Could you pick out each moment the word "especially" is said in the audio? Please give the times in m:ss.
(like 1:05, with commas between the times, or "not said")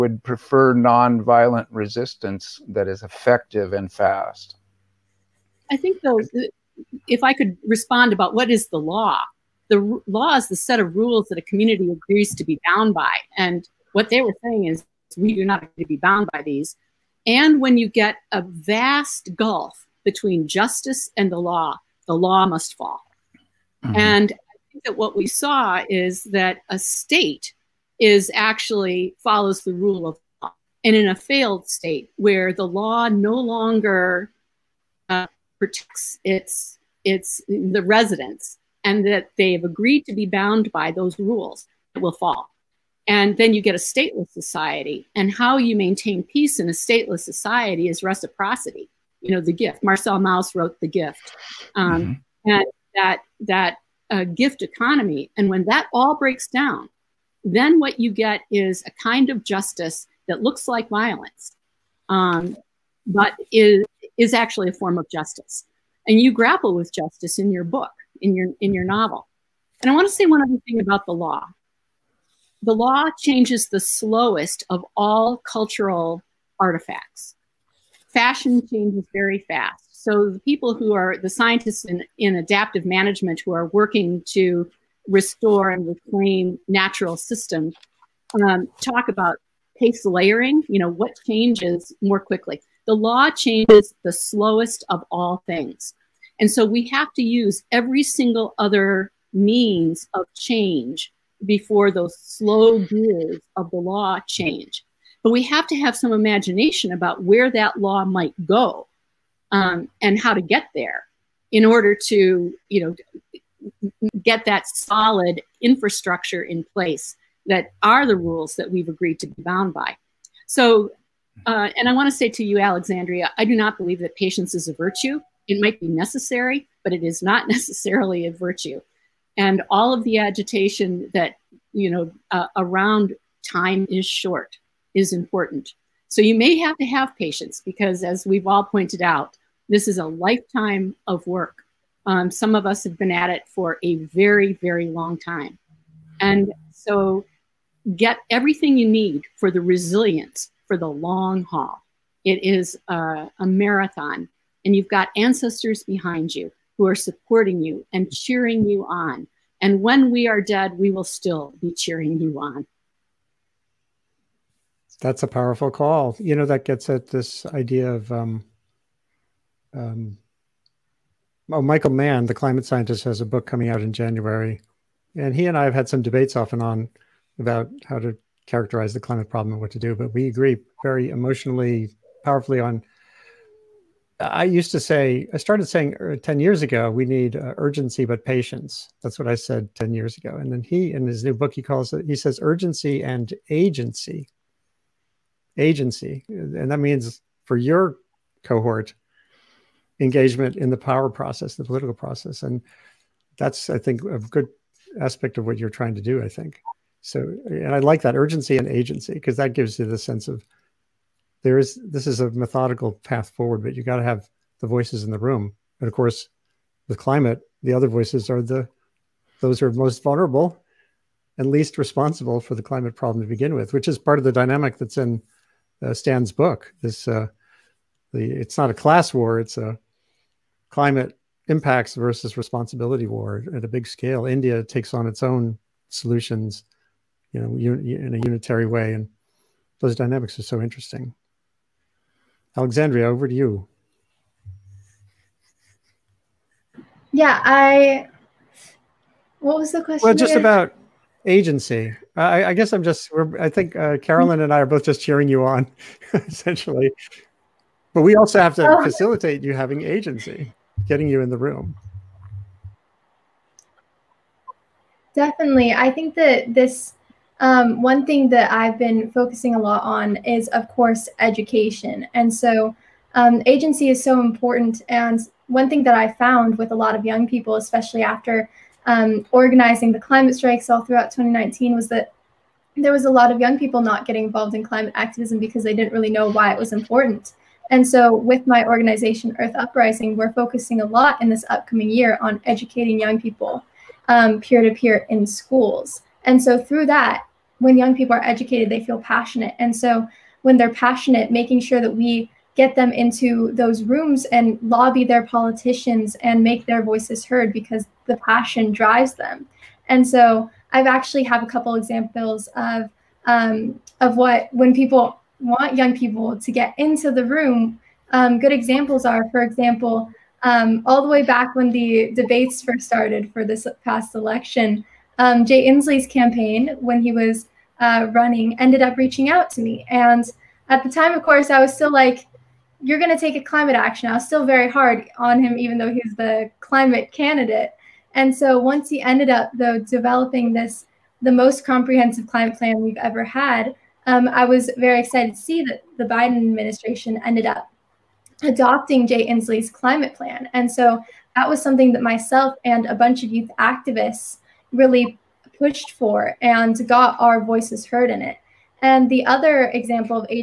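4:37.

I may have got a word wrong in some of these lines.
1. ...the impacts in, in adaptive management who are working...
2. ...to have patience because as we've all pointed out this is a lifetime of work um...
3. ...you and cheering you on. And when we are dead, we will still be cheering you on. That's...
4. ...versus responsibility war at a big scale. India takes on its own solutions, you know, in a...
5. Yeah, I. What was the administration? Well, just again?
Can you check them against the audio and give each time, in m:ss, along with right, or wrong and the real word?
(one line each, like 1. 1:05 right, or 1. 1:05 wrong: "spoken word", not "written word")
1. 1:21 wrong: "scientists", not "impacts"
2. 2:16 right
3. 2:37 right
4. 3:51 right
5. 4:07 wrong: "question", not "administration".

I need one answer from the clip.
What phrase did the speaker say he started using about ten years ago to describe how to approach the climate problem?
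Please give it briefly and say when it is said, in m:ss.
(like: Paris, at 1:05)
urgency but patience, at 3:07.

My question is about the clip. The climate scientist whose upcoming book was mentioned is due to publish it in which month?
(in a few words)
January.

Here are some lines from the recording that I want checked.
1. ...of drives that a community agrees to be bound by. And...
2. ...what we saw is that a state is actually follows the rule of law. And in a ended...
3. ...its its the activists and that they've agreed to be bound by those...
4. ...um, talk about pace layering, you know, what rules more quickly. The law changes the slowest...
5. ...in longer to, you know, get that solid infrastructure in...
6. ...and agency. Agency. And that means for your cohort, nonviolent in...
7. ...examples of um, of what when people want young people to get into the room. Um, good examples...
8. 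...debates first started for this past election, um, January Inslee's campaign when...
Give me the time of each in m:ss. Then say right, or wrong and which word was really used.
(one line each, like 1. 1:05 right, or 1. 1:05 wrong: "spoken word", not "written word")
1. 0:10 wrong: "rules", not "drives"
2. 0:24 wrong: "failed", not "ended"
3. 0:36 wrong: "residents", not "activists"
4. 1:28 wrong: "changes", not "rules"
5. 1:51 wrong: "order", not "longer"
6. 3:13 wrong: "engagement", not "nonviolent"
7. 5:11 right
8. 5:22 wrong: "Jay", not "January".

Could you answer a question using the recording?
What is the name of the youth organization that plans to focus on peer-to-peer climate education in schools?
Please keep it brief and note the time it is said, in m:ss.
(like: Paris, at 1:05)
Earth Uprising, at 4:49.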